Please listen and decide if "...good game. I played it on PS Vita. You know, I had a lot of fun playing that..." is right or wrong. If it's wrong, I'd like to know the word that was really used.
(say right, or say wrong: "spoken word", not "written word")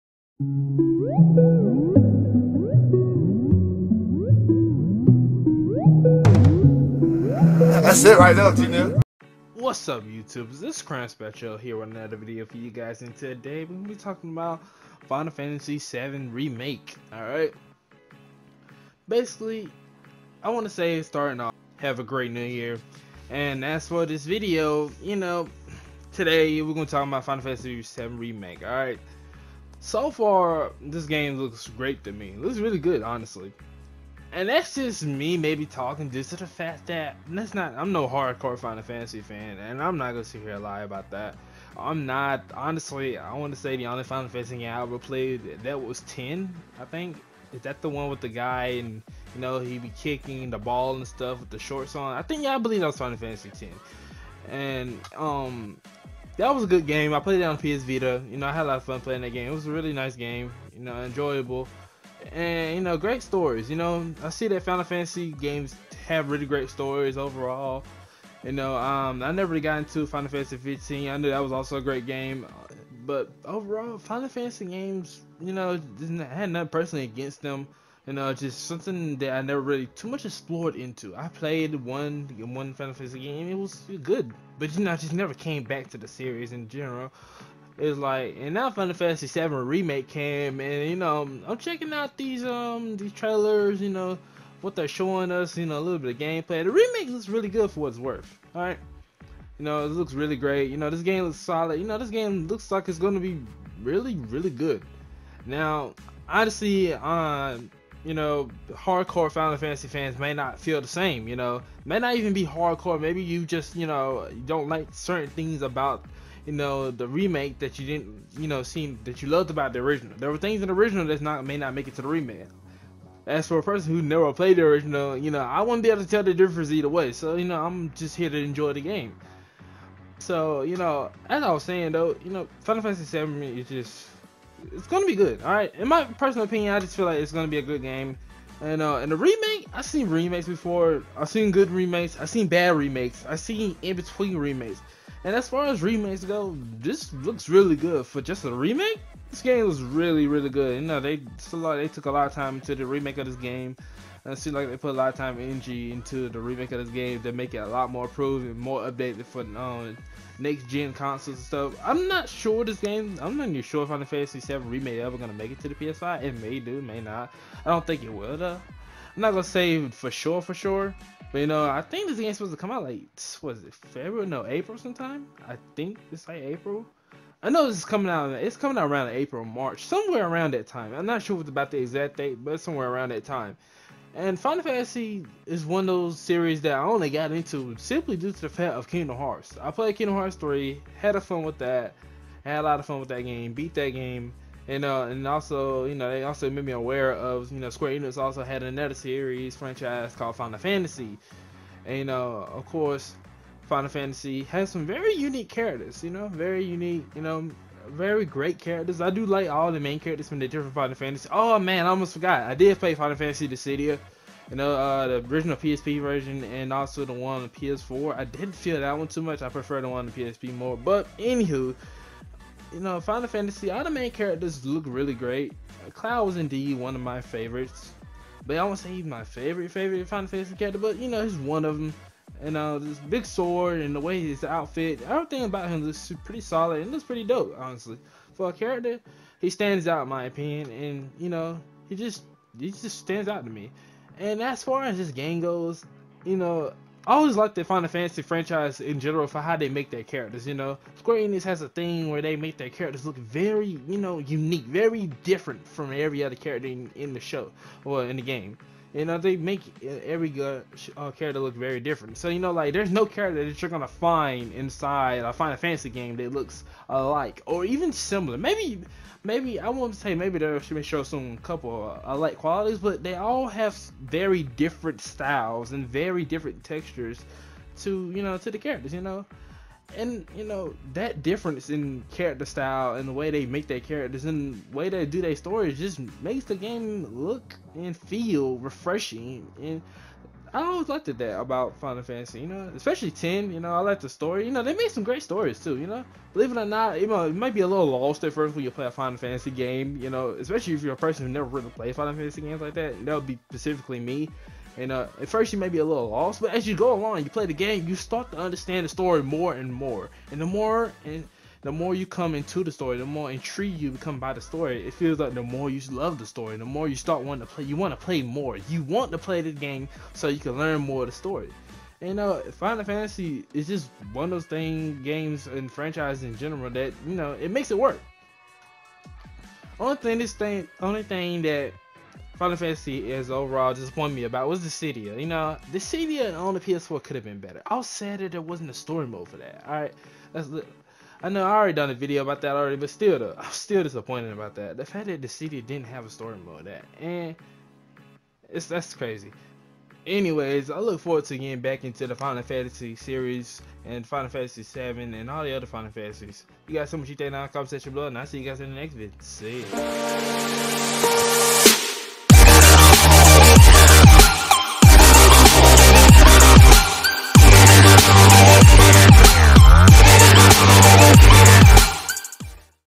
right.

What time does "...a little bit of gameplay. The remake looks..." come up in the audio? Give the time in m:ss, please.
1:35.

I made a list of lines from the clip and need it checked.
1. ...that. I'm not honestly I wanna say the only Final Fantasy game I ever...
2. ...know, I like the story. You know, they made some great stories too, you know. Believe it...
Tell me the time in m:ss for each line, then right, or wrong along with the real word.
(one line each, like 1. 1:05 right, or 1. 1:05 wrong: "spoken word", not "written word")
1. 0:41 right
2. 4:53 right.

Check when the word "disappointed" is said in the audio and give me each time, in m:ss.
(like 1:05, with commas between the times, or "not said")
5:33, 5:43.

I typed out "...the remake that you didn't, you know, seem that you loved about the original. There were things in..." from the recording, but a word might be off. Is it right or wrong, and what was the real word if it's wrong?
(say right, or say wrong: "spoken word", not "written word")
right.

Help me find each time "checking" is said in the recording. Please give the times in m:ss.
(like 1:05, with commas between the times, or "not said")
1:31.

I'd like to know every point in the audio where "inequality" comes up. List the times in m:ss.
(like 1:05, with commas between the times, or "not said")
not said.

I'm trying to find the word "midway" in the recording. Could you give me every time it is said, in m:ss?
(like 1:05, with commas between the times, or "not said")
not said.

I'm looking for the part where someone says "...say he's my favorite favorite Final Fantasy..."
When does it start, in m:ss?
3:48.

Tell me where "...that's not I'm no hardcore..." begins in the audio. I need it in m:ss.
0:37.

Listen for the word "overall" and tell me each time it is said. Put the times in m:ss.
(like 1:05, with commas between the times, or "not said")
1:07, 1:13, 5:33.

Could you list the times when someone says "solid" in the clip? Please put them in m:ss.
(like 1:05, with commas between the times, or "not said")
1:41, 3:56.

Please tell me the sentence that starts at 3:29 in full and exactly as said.
I do like all the main characters from the different Final Fantasy.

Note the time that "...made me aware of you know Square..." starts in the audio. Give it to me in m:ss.
3:16.